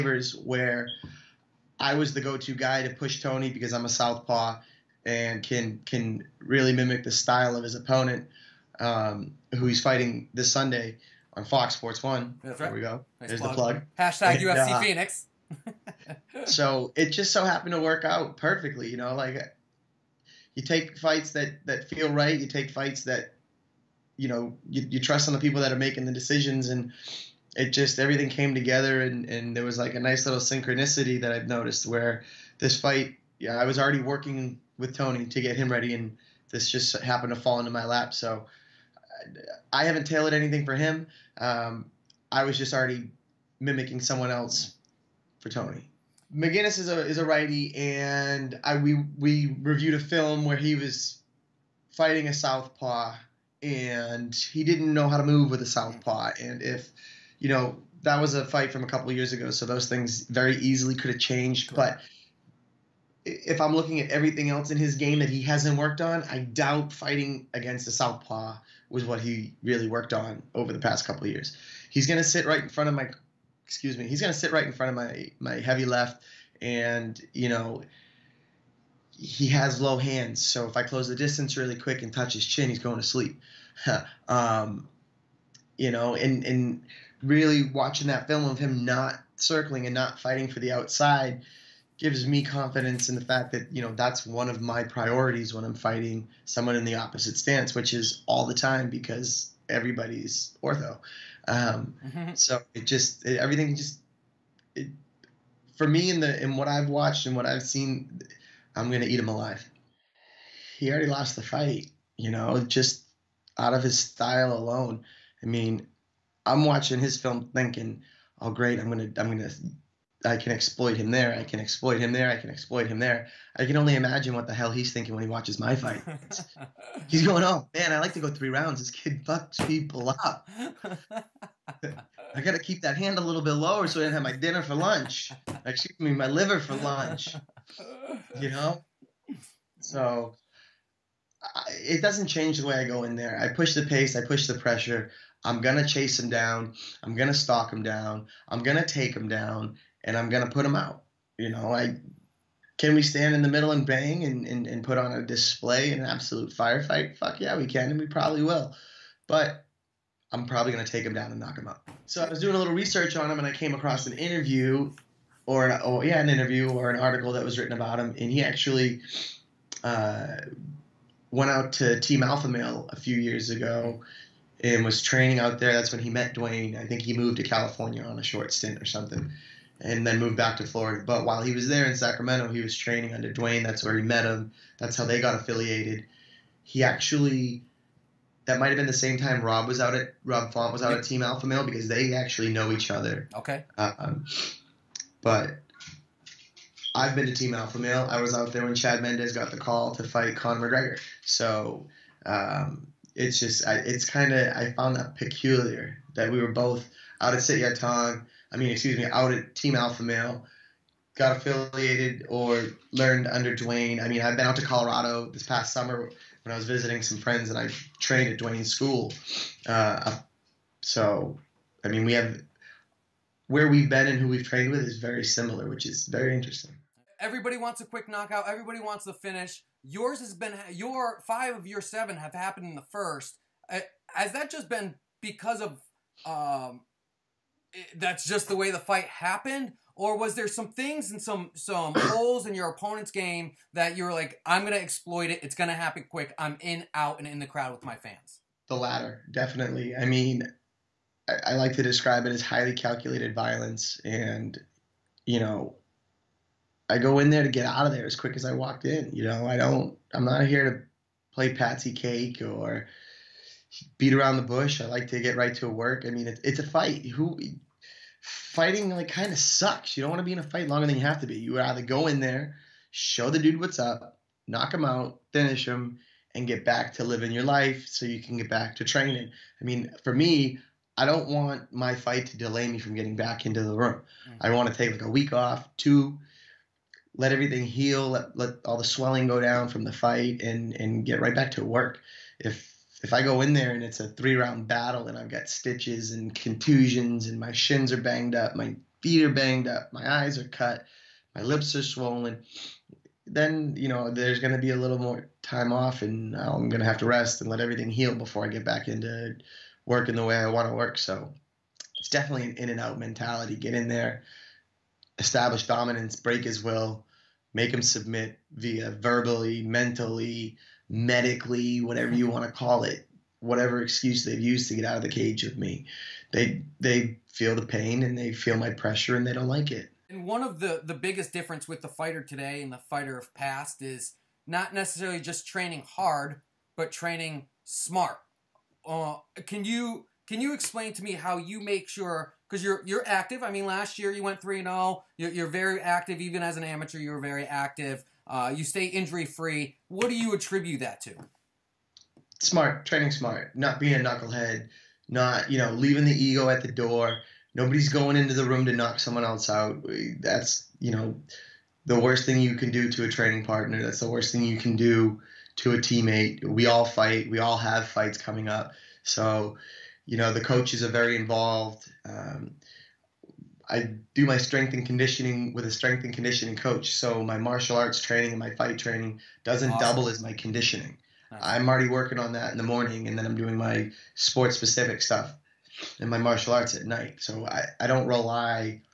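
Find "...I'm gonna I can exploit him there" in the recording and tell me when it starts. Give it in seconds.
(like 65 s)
119 s.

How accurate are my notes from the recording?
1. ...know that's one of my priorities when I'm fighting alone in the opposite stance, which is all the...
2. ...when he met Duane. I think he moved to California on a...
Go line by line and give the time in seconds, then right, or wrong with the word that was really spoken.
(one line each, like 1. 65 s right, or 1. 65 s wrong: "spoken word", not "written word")
1. 93 s wrong: "someone", not "alone"
2. 175 s right.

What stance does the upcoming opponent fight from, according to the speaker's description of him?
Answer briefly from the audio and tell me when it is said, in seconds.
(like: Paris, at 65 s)
Righty, at 47 s.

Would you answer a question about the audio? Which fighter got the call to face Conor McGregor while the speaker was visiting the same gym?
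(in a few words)
Chad Mendes.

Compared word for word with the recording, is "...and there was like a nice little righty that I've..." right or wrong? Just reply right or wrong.
wrong.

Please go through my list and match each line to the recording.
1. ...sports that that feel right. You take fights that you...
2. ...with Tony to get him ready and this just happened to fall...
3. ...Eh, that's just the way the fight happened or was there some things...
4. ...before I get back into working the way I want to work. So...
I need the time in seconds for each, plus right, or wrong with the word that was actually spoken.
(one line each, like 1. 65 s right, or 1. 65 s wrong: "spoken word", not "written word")
1. 20 s wrong: "fights", not "sports"
2. 34 s right
3. 237 s right
4. 308 s right.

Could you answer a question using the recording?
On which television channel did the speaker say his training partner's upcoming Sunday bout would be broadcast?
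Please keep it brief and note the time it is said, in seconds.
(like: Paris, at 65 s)
Fox Sports One, at 11 s.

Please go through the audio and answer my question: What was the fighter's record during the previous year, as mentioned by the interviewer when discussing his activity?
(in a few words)
3-0.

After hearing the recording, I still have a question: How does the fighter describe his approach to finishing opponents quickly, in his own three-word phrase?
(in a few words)
Highly calculated violence.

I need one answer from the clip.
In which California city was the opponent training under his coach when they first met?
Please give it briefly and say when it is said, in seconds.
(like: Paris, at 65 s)
Sacramento, at 181 s.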